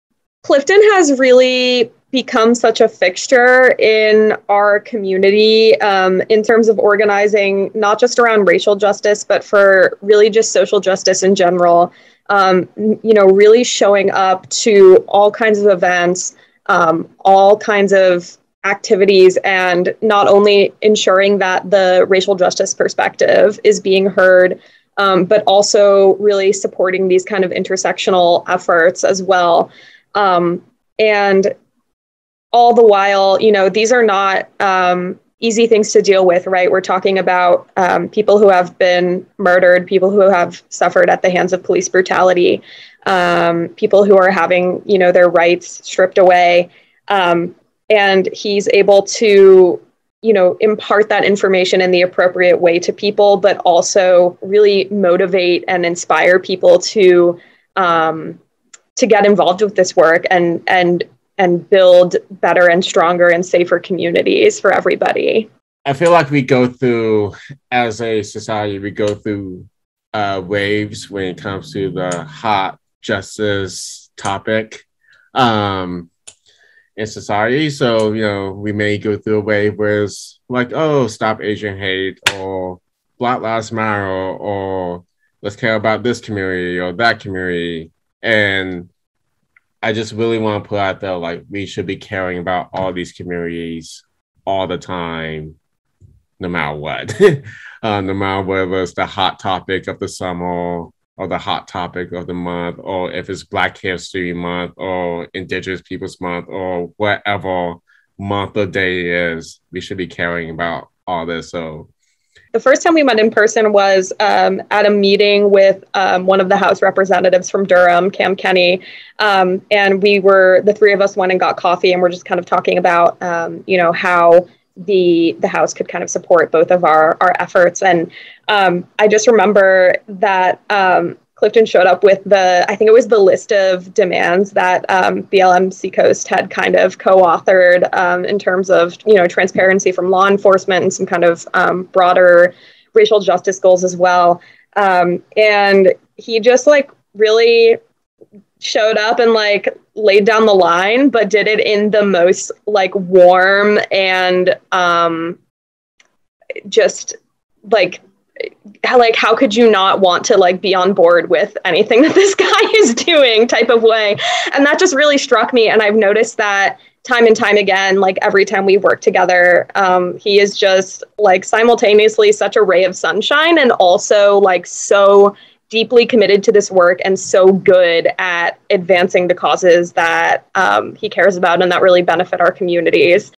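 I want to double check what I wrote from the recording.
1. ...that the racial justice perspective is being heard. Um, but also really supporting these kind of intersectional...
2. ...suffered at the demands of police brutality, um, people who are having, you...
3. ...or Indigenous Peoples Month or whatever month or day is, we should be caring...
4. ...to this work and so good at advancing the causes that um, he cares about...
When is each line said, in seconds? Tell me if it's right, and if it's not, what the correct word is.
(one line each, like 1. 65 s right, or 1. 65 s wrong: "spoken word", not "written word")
1. 21 s right
2. 40 s wrong: "hands", not "demands"
3. 104 s right
4. 176 s right.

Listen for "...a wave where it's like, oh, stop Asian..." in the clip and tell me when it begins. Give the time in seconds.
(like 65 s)
79 s.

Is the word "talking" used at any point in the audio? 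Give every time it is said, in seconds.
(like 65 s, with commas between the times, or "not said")
36 s, 122 s.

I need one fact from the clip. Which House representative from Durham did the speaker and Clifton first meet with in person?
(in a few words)
Cam Kenney.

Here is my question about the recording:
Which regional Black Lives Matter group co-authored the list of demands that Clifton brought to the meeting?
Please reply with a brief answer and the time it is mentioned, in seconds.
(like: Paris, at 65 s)
BLM Seacoast, at 135 s.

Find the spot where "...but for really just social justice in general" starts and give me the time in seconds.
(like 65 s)
9 s.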